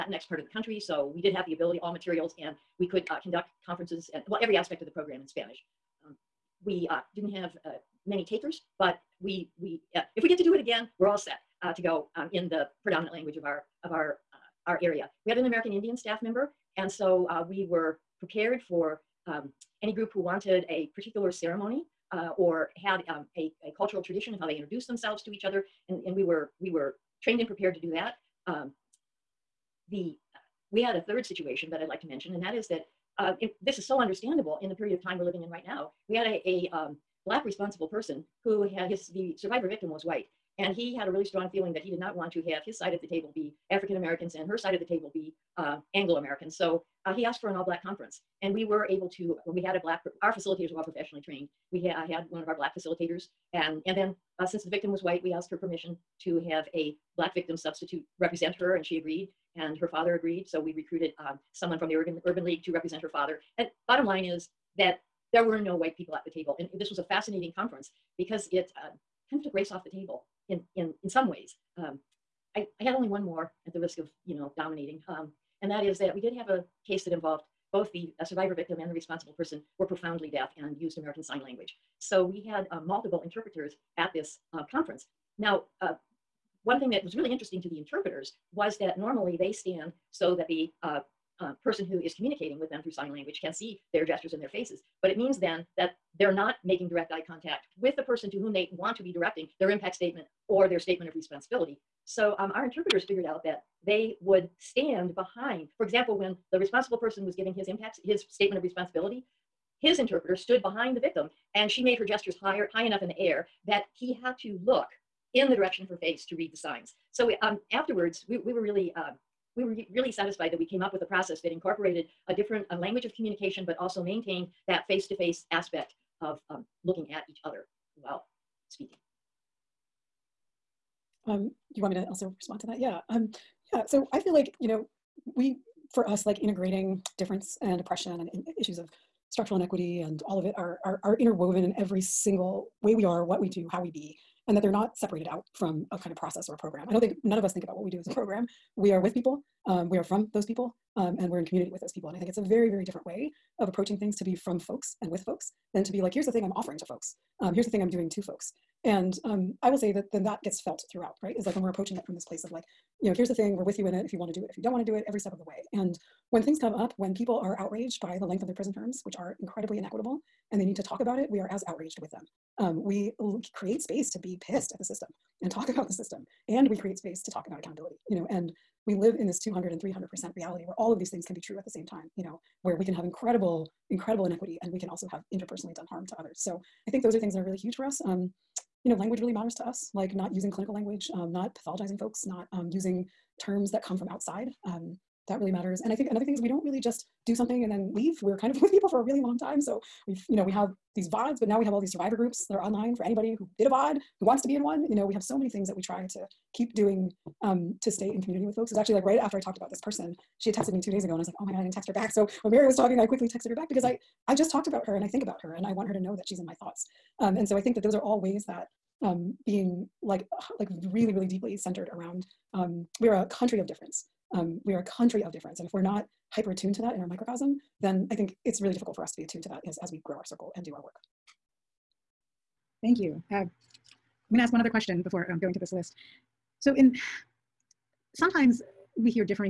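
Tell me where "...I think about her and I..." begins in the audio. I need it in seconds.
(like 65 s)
215 s.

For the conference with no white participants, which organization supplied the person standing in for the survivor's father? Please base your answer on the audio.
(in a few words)
Urban League.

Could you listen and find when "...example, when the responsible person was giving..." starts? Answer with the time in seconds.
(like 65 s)
105 s.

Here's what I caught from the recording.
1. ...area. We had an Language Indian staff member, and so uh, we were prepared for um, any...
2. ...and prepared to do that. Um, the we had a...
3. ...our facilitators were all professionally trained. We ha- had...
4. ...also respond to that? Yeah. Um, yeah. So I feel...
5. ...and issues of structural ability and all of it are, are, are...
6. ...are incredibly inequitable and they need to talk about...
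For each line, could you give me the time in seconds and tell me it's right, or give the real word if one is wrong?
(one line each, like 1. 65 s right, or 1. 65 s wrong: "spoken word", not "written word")
1. 14 s wrong: "American", not "Language"
2. 27 s right
3. 50 s right
4. 132 s right
5. 138 s wrong: "inequity", not "ability"
6. 169 s right.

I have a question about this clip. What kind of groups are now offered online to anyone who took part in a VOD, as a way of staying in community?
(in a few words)
survivor groups.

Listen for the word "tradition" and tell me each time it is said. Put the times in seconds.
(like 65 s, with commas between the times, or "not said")
24 s.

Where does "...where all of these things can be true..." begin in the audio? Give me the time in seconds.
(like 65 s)
180 s.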